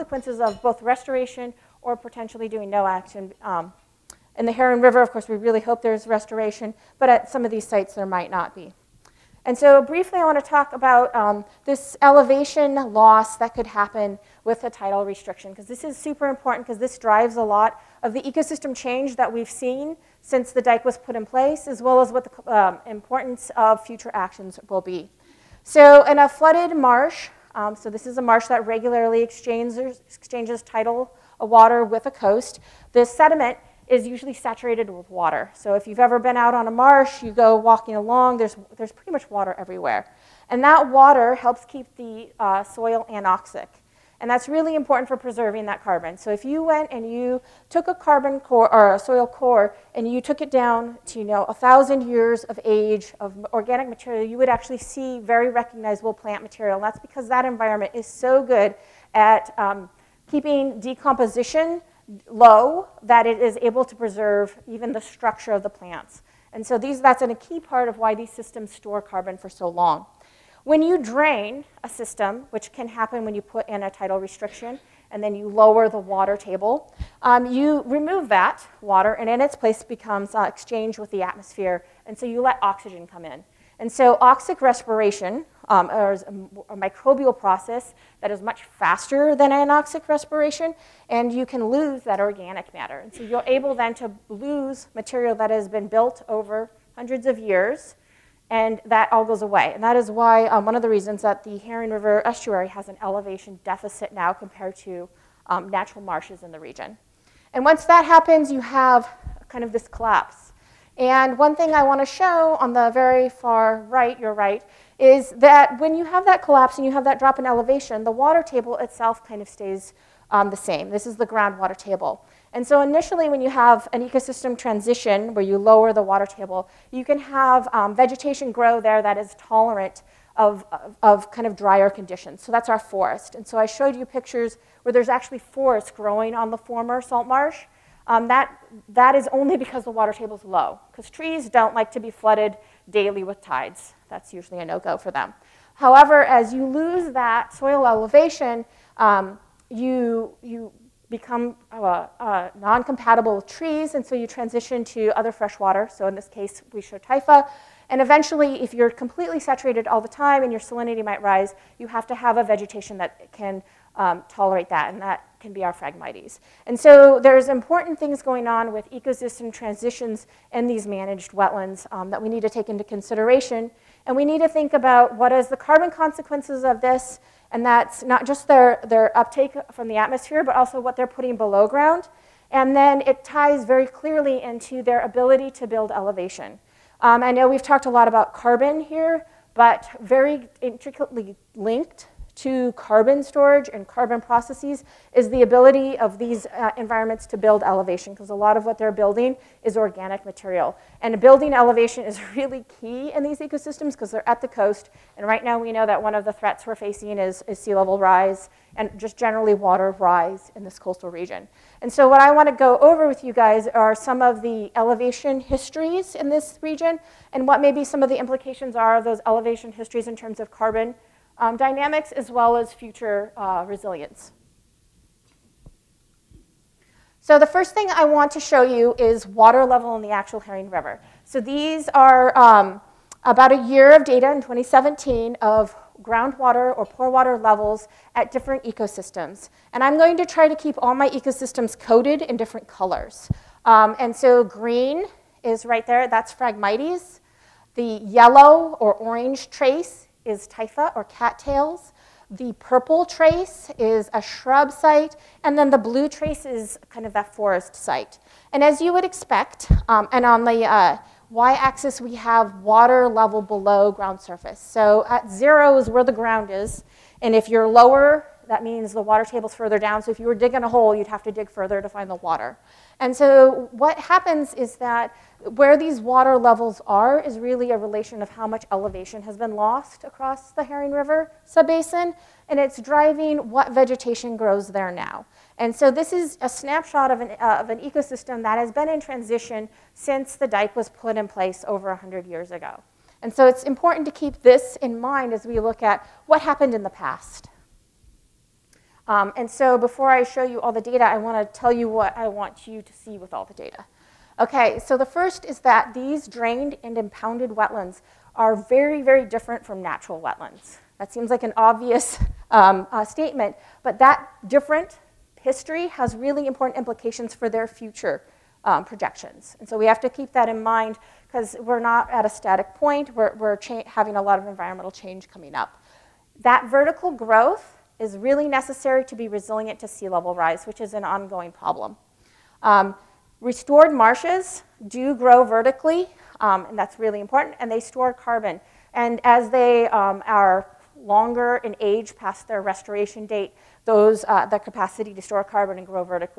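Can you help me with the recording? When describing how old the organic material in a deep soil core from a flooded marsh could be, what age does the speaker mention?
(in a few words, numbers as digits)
1000 years.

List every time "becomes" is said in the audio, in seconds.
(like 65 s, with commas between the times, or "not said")
79 s, 151 s.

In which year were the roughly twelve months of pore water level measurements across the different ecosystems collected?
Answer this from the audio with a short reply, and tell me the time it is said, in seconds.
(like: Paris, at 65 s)
2017, at 234 s.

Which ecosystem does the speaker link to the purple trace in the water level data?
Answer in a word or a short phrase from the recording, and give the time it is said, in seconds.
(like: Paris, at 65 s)
shrub site, at 254 s.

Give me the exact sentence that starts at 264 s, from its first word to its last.
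So at zero is where the ground is, and if you're lower, that means the water table's further down.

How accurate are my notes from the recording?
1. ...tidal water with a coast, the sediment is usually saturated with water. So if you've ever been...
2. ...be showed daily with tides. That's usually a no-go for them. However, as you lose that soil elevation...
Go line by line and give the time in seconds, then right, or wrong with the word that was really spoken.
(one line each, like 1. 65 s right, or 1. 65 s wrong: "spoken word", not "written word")
1. 30 s right
2. 142 s wrong: "flooded", not "showed".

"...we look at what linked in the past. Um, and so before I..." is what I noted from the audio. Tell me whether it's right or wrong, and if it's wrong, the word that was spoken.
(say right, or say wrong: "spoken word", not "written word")
wrong: "happened", not "linked".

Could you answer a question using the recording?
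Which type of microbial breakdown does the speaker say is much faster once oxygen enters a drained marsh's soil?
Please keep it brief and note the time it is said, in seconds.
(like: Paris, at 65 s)
oxic respiration, at 84 s.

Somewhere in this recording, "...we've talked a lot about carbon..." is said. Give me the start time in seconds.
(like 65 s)
187 s.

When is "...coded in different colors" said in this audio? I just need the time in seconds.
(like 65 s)
241 s.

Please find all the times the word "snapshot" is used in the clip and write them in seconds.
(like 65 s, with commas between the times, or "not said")
286 s.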